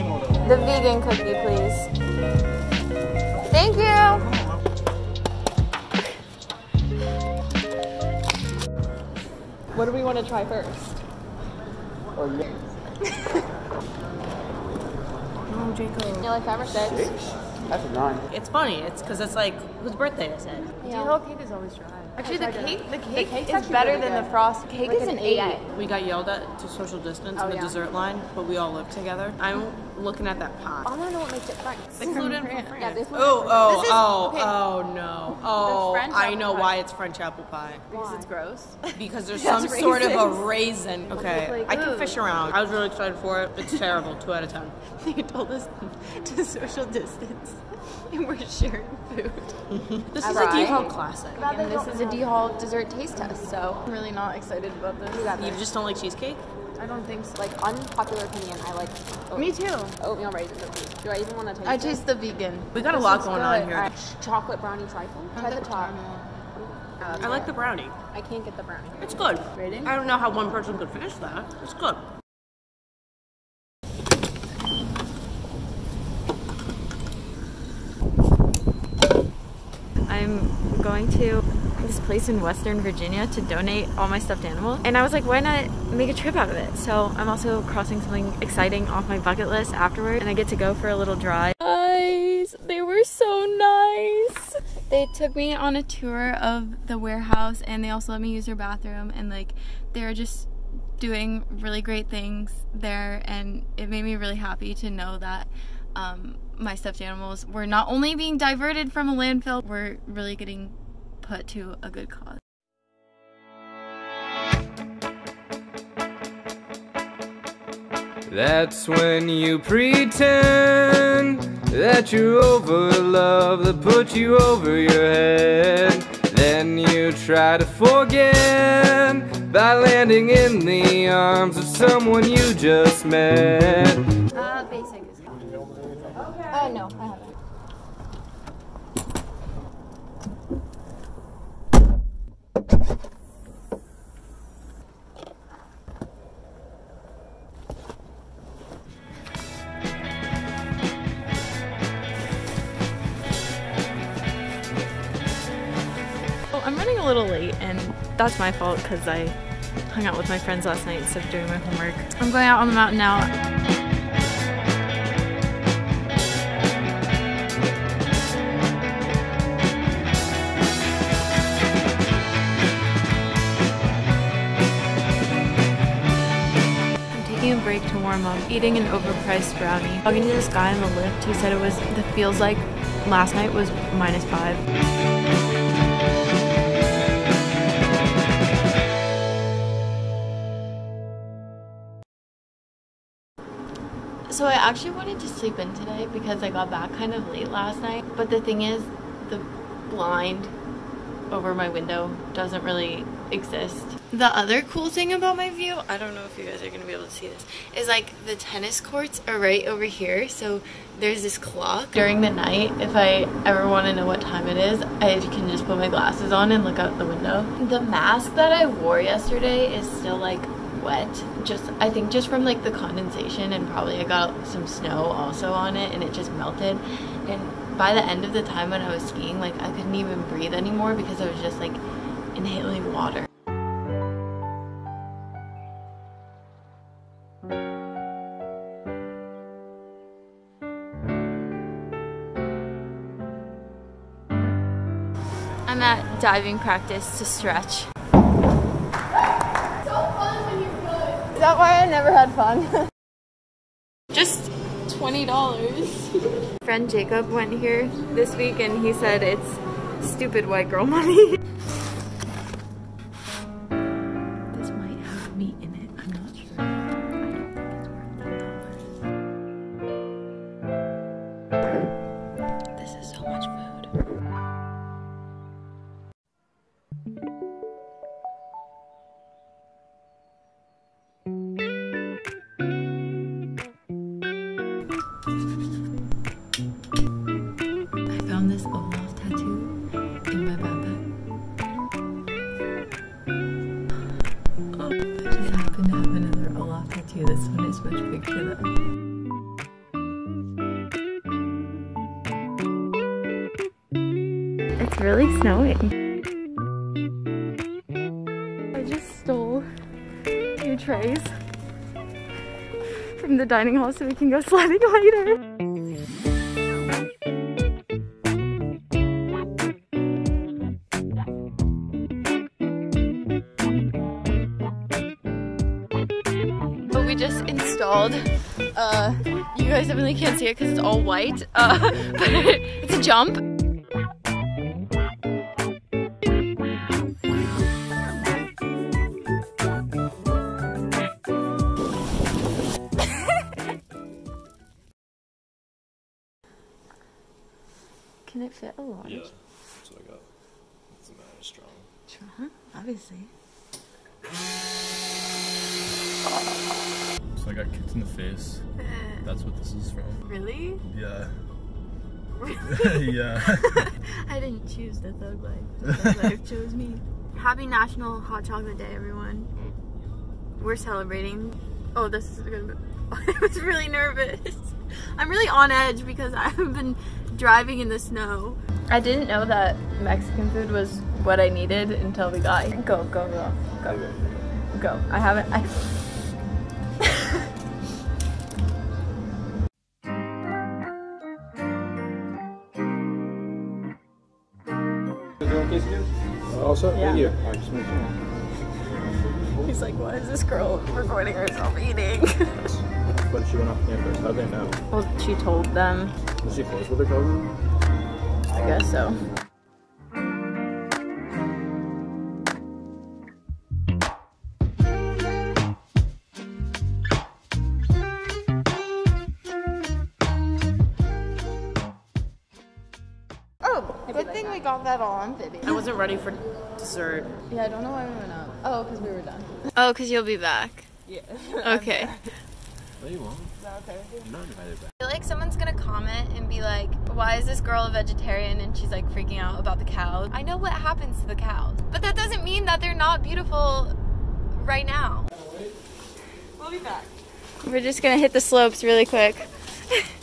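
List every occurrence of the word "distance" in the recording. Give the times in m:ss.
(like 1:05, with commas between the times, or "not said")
0:26, 0:46.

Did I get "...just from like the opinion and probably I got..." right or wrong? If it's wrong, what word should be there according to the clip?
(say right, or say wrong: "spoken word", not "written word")
wrong: "condensation", not "opinion".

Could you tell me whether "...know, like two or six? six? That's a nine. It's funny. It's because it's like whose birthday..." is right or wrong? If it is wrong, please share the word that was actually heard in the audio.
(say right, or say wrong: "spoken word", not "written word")
wrong: "five", not "two".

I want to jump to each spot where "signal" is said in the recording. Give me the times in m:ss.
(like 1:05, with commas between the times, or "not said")
not said.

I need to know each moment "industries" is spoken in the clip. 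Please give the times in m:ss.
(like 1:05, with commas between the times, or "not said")
not said.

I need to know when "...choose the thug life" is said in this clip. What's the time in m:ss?
6:04.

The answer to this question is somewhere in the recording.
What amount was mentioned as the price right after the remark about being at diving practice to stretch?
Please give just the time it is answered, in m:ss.
4:14.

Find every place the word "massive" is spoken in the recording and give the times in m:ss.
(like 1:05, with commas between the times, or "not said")
not said.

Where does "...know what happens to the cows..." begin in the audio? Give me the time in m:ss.
7:20.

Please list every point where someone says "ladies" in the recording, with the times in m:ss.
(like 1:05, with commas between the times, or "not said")
not said.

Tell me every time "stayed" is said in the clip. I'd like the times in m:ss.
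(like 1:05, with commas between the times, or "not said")
not said.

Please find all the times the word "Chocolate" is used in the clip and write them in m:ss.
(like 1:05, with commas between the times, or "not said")
1:04, 6:08.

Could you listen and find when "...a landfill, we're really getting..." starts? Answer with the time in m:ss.
1:49.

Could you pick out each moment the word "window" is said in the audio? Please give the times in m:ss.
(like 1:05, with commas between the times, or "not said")
3:21, 3:37.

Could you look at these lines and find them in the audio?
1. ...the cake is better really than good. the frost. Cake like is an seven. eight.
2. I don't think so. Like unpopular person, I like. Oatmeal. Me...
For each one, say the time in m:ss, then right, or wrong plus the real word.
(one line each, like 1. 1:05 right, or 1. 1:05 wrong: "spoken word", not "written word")
1. 0:23 wrong: "eight", not "seven"
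2. 0:56 wrong: "opinion", not "person".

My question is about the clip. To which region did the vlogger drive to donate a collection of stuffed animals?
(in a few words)
Western Virginia.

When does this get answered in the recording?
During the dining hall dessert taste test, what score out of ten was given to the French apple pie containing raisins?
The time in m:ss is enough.
0:44.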